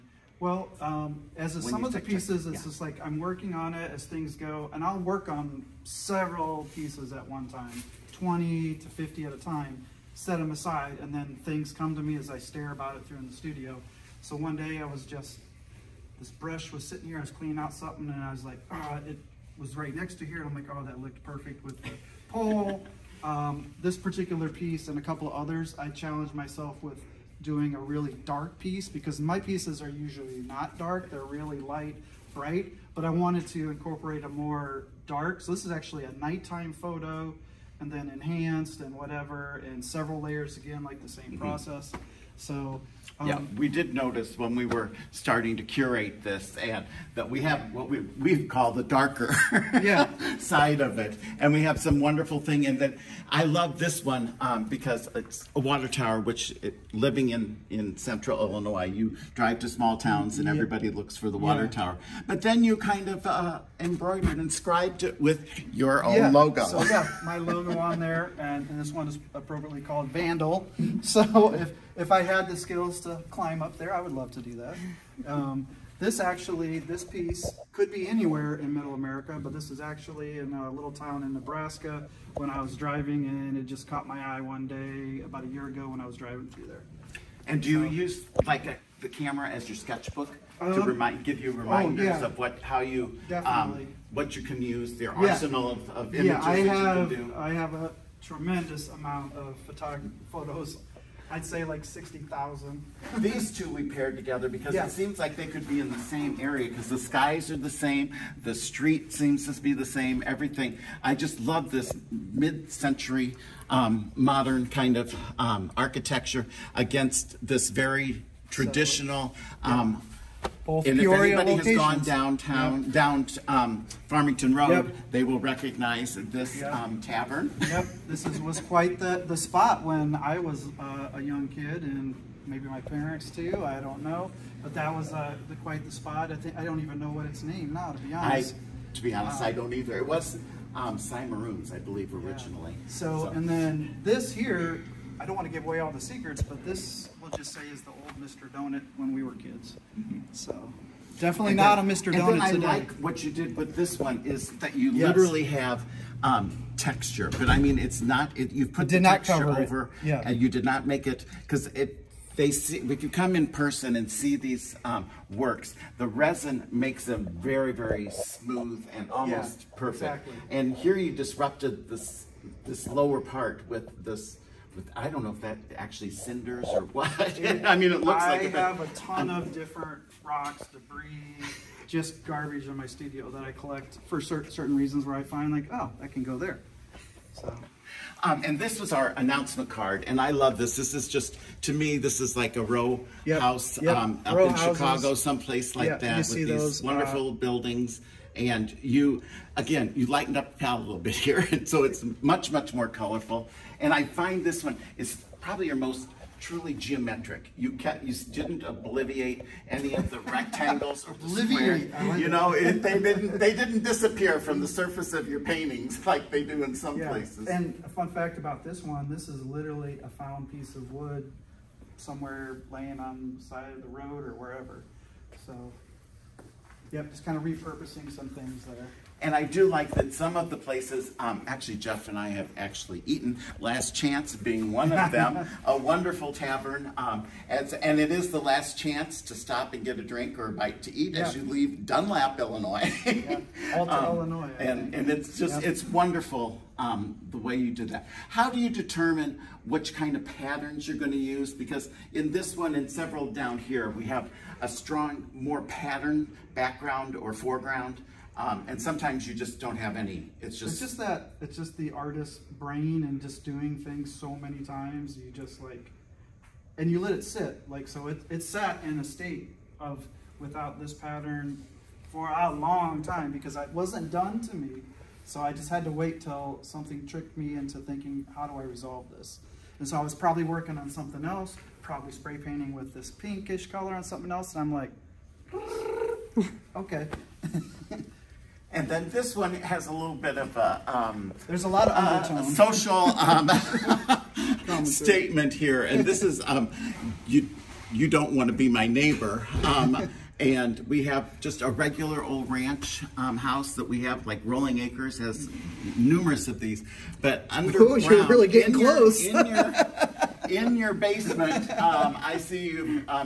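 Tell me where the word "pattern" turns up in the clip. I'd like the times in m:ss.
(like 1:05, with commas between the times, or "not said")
4:10, 4:15, 4:30.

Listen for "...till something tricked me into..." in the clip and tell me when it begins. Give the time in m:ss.
4:36.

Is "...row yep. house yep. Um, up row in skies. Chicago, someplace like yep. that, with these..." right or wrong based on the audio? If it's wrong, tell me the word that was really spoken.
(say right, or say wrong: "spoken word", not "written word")
wrong: "houses", not "skies".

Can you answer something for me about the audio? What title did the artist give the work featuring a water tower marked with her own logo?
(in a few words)
Vandal.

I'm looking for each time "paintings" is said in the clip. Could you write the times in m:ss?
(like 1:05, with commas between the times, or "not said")
3:35, 4:42.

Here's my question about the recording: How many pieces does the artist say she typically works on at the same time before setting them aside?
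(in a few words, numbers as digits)
20 to 50.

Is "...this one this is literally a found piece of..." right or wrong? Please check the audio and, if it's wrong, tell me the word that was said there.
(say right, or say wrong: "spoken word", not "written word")
right.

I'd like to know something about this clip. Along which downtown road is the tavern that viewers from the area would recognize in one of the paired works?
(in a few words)
Farmington Road.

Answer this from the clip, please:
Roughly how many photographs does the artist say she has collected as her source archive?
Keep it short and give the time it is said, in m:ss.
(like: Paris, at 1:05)
60,000, at 1:41.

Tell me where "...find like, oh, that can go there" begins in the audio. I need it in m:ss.
3:05.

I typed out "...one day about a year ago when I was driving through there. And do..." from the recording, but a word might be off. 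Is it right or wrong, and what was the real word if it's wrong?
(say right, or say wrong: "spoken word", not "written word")
right.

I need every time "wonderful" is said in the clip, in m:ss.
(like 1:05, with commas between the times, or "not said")
0:51, 3:16, 3:55, 4:05.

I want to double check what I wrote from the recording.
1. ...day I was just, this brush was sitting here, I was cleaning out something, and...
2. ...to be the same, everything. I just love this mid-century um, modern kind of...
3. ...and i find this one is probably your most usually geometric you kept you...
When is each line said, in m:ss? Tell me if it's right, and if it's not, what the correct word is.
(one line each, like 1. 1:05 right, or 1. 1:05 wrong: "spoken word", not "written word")
1. 0:14 right
2. 1:49 right
3. 3:23 wrong: "truly", not "usually".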